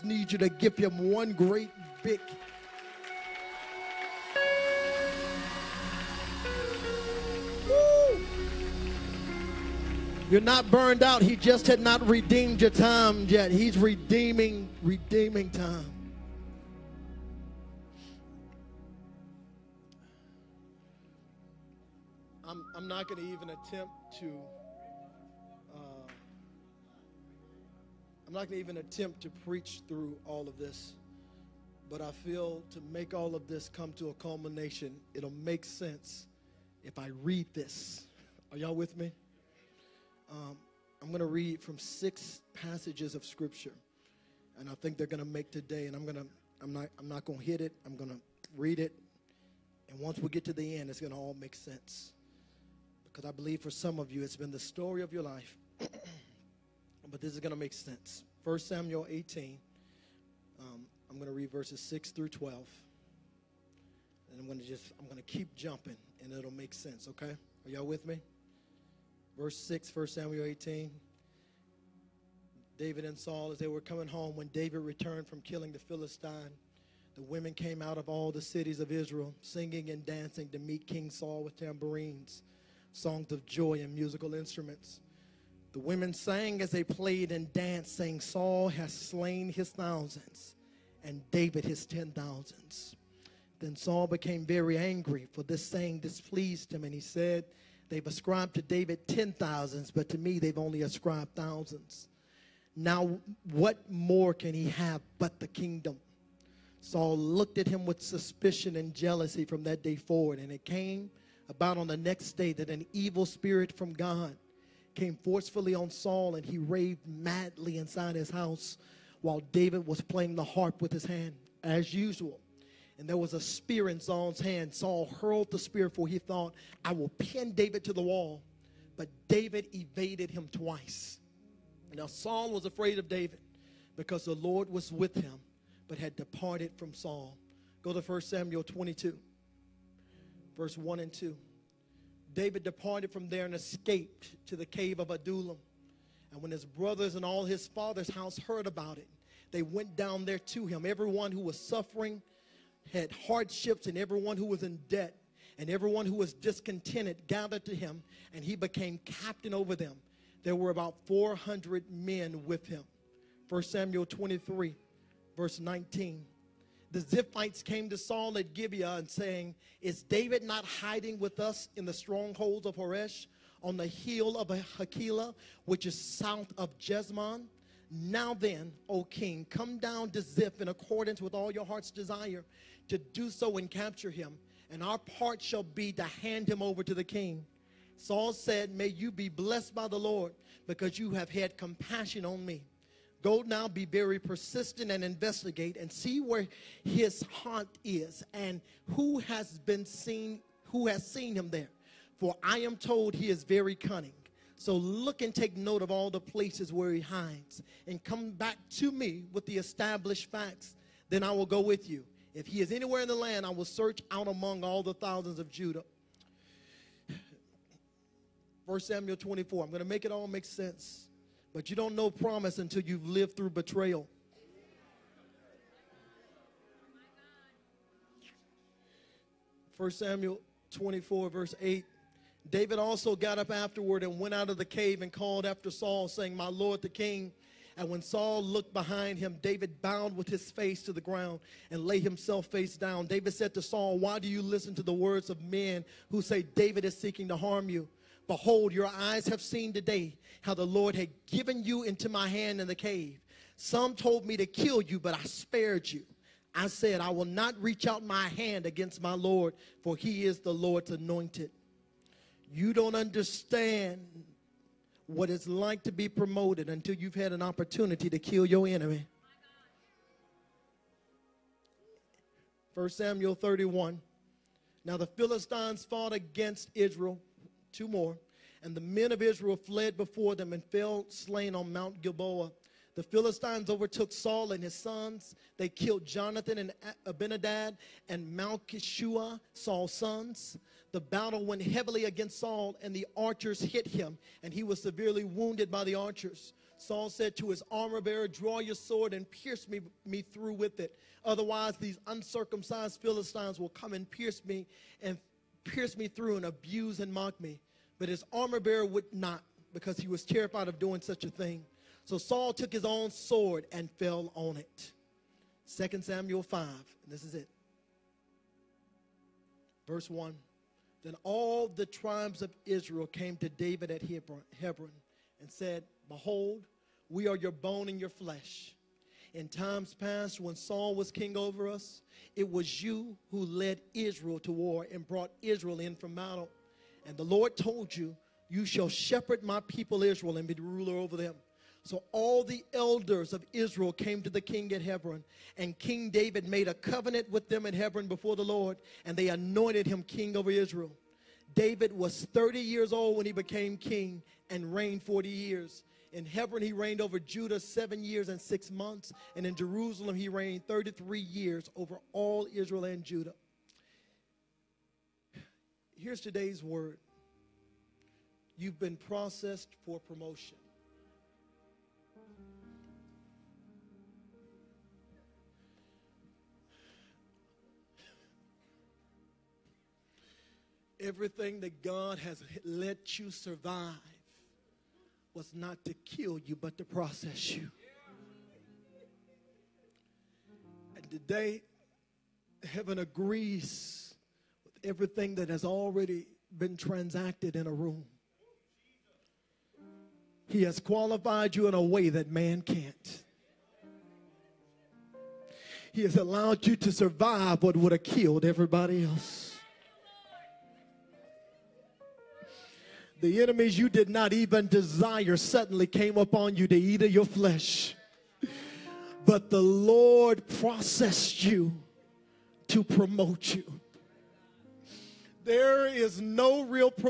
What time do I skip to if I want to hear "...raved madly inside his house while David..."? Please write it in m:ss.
1:56.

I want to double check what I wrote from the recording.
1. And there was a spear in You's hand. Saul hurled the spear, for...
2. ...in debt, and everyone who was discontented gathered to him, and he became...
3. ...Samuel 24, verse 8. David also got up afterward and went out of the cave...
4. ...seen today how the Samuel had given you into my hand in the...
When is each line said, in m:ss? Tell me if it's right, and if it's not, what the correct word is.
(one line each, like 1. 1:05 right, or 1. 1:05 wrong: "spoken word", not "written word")
1. 2:02 wrong: "Saul", not "You"
2. 2:34 right
3. 3:50 right
4. 4:09 wrong: "Lord", not "Samuel".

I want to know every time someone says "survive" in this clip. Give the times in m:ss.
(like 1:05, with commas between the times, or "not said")
6:23, 6:46.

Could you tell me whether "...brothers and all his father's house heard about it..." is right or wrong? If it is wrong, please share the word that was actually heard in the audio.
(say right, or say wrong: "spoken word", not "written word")
right.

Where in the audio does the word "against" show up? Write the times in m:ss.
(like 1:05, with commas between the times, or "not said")
4:18, 4:36, 4:52.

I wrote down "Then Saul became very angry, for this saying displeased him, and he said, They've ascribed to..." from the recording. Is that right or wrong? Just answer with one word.
right.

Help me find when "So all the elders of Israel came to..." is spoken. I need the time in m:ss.
5:41.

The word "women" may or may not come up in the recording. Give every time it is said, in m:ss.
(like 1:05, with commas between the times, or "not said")
1:17, 1:25.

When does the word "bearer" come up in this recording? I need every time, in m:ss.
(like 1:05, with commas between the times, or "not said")
4:58, 5:08.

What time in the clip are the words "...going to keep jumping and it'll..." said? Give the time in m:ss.
1:05.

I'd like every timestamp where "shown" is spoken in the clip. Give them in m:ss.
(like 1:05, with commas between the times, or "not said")
not said.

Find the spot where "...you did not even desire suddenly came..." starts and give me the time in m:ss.
6:53.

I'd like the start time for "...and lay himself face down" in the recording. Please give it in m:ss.
4:01.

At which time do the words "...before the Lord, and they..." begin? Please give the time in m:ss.
5:48.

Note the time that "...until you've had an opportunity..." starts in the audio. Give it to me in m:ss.
4:26.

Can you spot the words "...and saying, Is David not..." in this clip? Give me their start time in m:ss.
2:48.